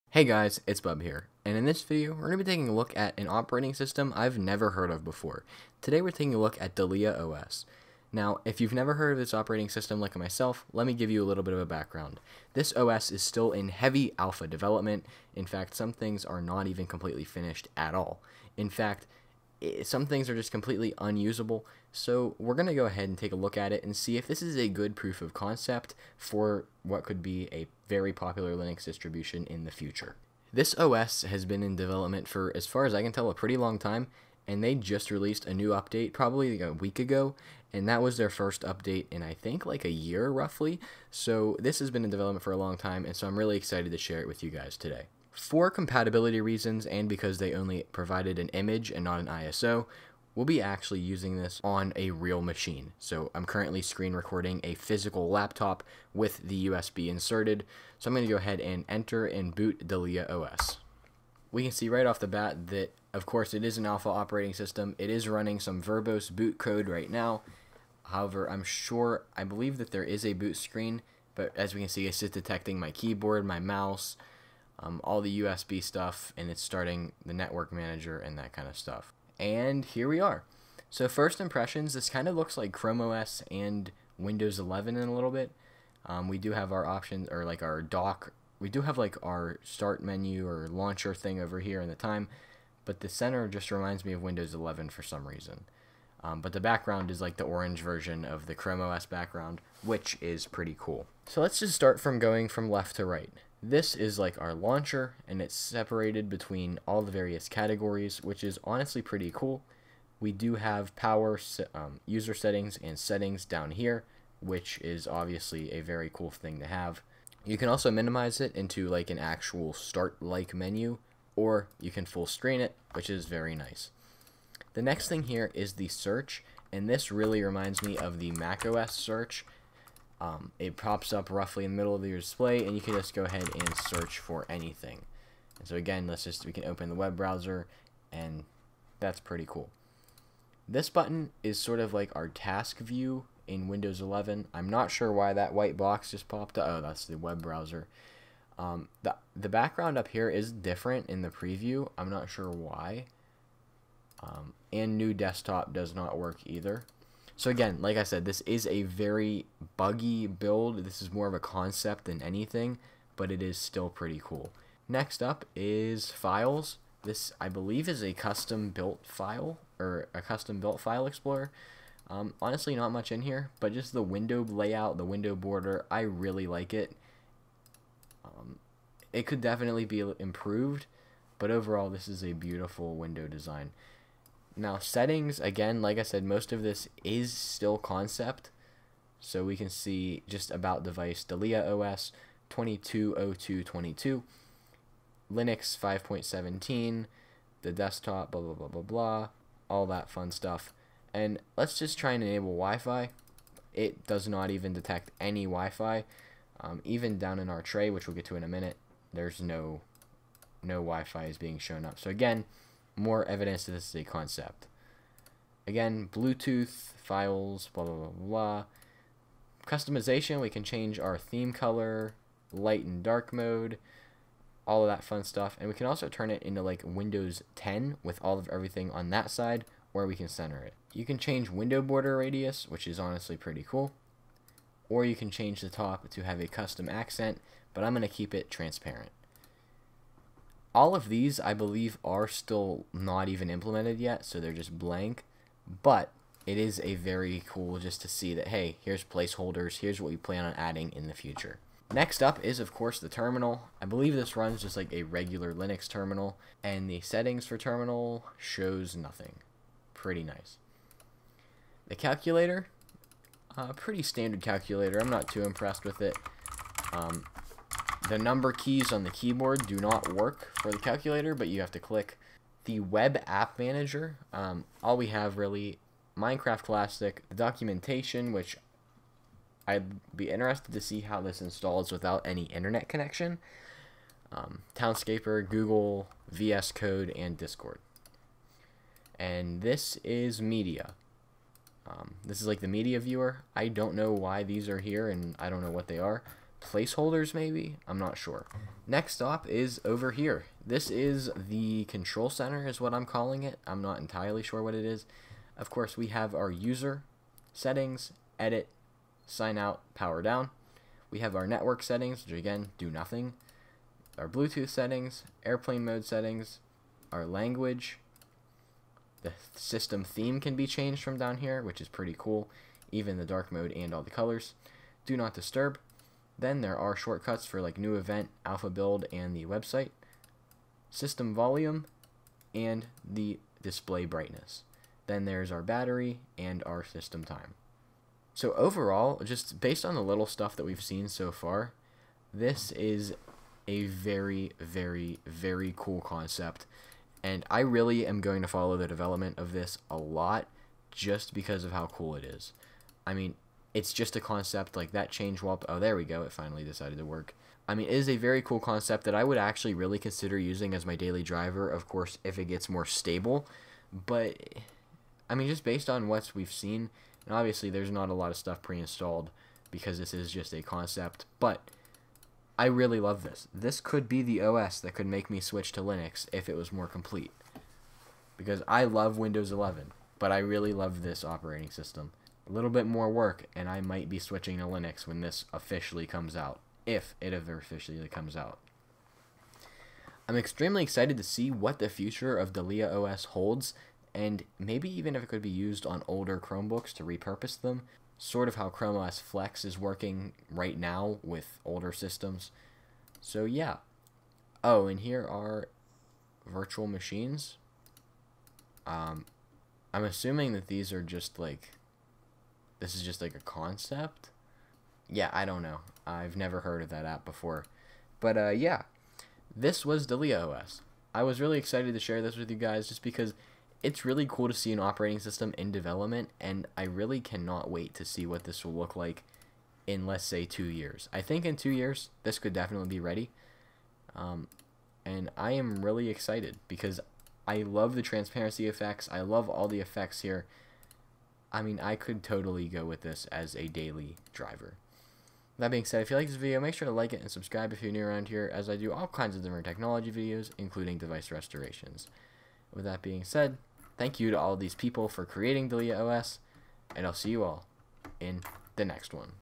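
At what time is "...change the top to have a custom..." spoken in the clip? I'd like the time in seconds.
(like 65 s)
235 s.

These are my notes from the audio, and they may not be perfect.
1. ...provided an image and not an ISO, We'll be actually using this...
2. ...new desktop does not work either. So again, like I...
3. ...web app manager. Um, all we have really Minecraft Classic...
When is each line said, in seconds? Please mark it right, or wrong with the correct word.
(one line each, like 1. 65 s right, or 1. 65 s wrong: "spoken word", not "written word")
1. 47 s right
2. 154 s right
3. 272 s right.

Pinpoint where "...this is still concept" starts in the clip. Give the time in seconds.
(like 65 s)
186 s.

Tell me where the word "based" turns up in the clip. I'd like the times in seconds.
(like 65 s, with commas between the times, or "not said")
339 s, 365 s.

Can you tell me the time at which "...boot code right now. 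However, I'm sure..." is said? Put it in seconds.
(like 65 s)
66 s.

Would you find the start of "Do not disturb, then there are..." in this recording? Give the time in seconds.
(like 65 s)
325 s.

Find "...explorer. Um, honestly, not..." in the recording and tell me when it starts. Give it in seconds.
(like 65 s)
171 s.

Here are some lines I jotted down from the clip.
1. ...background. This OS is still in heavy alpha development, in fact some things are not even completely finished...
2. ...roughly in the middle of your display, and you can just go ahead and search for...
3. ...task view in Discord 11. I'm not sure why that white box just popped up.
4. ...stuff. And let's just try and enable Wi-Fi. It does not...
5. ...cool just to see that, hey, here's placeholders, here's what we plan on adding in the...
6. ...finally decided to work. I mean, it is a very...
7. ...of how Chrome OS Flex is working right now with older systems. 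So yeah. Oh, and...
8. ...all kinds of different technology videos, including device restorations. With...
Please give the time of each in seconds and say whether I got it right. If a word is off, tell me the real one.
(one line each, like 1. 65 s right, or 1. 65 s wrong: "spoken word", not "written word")
1. 11 s right
2. 131 s right
3. 142 s wrong: "Windows", not "Discord"
4. 200 s right
5. 247 s right
6. 356 s right
7. 398 s right
8. 448 s right.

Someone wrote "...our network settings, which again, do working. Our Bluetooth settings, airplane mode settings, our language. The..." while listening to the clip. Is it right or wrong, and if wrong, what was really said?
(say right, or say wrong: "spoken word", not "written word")
wrong: "nothing", not "working".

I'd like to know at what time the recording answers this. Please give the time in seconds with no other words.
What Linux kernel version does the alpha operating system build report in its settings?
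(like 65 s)
195 s.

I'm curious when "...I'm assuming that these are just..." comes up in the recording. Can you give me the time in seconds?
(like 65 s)
409 s.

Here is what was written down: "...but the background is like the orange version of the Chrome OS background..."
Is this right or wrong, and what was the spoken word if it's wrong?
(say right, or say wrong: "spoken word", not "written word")
right.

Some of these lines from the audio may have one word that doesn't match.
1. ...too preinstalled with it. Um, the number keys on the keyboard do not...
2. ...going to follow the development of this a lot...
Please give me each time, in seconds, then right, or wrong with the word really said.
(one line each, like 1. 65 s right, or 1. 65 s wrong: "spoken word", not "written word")
1. 265 s wrong: "impressed", not "preinstalled"
2. 348 s right.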